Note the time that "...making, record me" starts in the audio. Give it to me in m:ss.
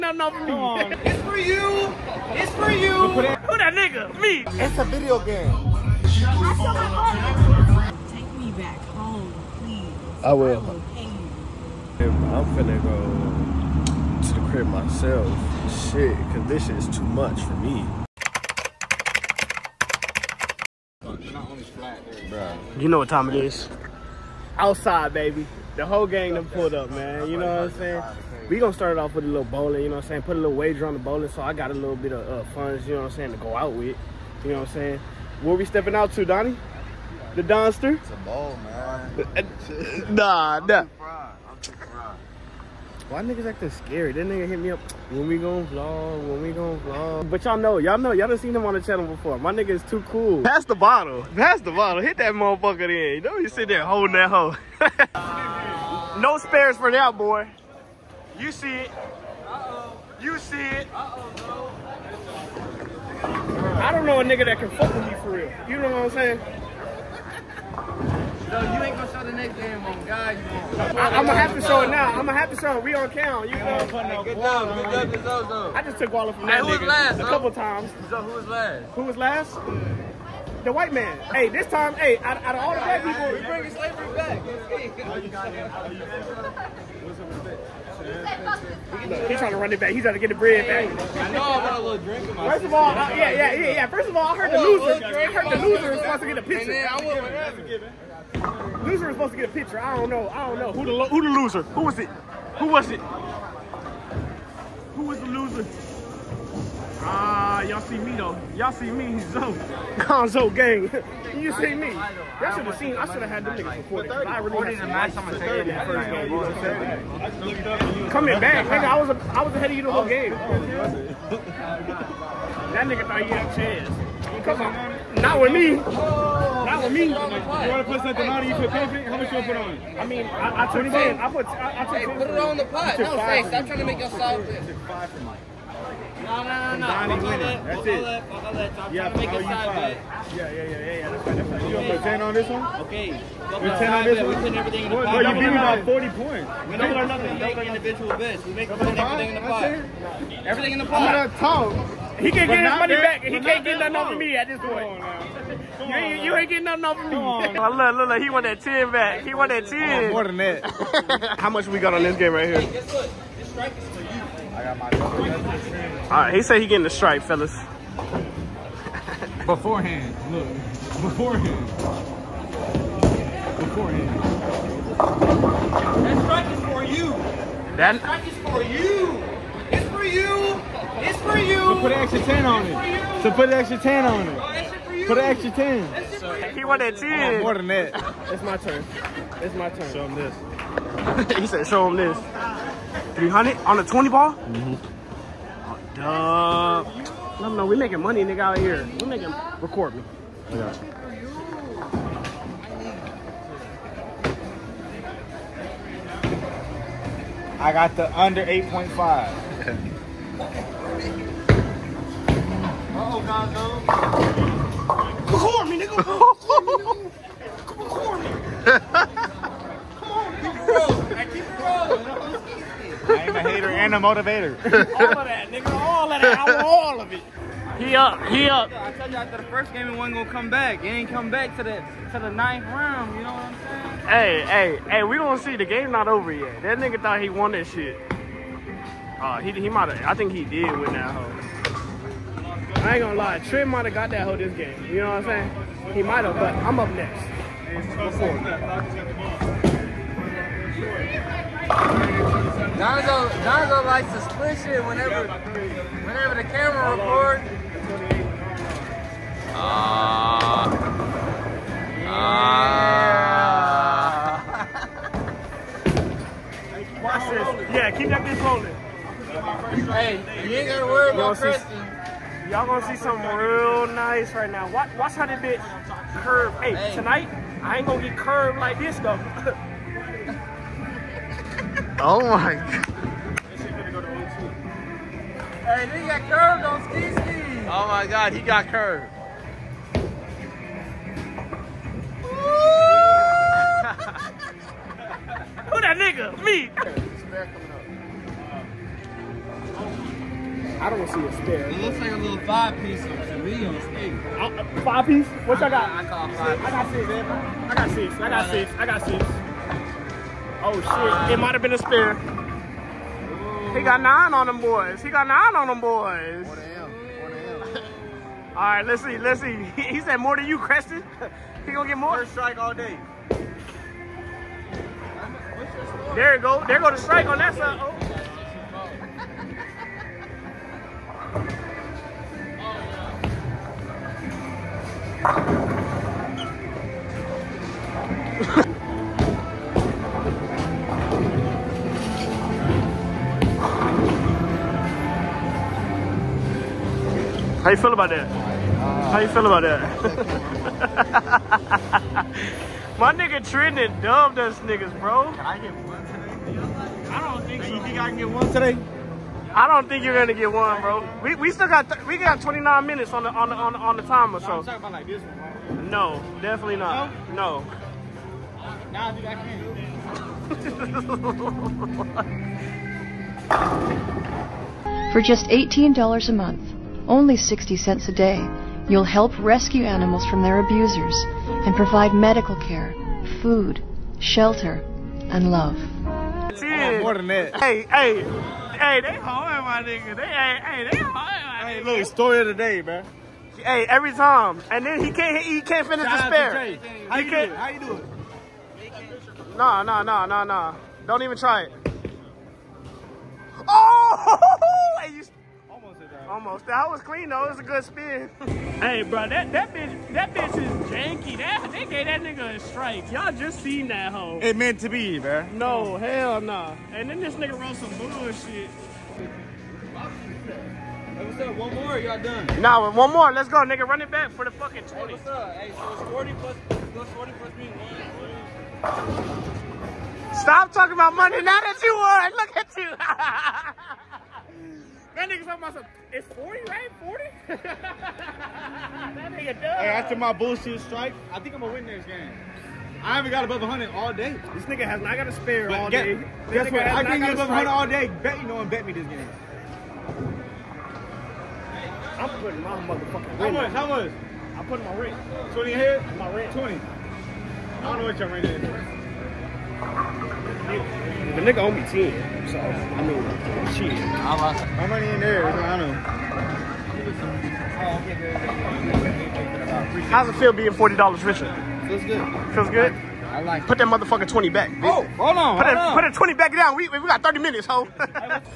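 3:19.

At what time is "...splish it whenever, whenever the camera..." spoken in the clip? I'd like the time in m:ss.
4:14.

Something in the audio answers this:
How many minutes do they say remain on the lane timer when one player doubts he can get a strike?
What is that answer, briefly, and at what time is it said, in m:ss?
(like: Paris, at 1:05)
29, at 6:02.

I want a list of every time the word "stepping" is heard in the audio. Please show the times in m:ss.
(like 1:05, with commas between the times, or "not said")
0:35.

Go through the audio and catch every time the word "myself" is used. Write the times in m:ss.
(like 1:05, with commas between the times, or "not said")
0:14.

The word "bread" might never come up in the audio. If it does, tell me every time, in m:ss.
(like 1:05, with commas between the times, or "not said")
1:30.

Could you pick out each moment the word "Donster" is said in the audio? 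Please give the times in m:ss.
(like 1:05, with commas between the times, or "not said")
0:37.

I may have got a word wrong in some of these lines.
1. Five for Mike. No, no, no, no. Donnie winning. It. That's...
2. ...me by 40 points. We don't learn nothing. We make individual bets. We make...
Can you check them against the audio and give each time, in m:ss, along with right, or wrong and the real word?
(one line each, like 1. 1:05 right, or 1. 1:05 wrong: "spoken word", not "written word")
1. 2:14 right
2. 2:25 right.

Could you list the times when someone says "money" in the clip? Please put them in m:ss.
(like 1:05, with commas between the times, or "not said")
2:32, 3:17, 7:11, 7:44.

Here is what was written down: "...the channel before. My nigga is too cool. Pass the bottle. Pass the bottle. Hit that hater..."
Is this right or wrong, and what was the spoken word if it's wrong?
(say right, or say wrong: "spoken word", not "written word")
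wrong: "motherfucker", not "hater".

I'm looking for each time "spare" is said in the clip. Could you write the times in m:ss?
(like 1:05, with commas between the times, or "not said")
0:56, 5:01, 6:36, 7:25.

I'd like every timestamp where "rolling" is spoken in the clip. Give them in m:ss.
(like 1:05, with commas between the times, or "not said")
4:28.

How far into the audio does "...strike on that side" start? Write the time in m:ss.
5:26.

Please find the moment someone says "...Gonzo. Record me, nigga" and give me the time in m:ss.
3:34.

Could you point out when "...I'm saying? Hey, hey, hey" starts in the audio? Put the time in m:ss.
3:54.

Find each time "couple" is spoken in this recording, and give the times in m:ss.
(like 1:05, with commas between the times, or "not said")
1:17.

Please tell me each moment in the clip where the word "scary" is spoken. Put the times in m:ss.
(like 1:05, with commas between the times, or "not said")
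0:43.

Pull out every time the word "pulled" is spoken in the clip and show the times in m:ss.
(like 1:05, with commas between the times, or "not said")
0:26.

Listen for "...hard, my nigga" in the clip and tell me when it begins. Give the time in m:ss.
6:29.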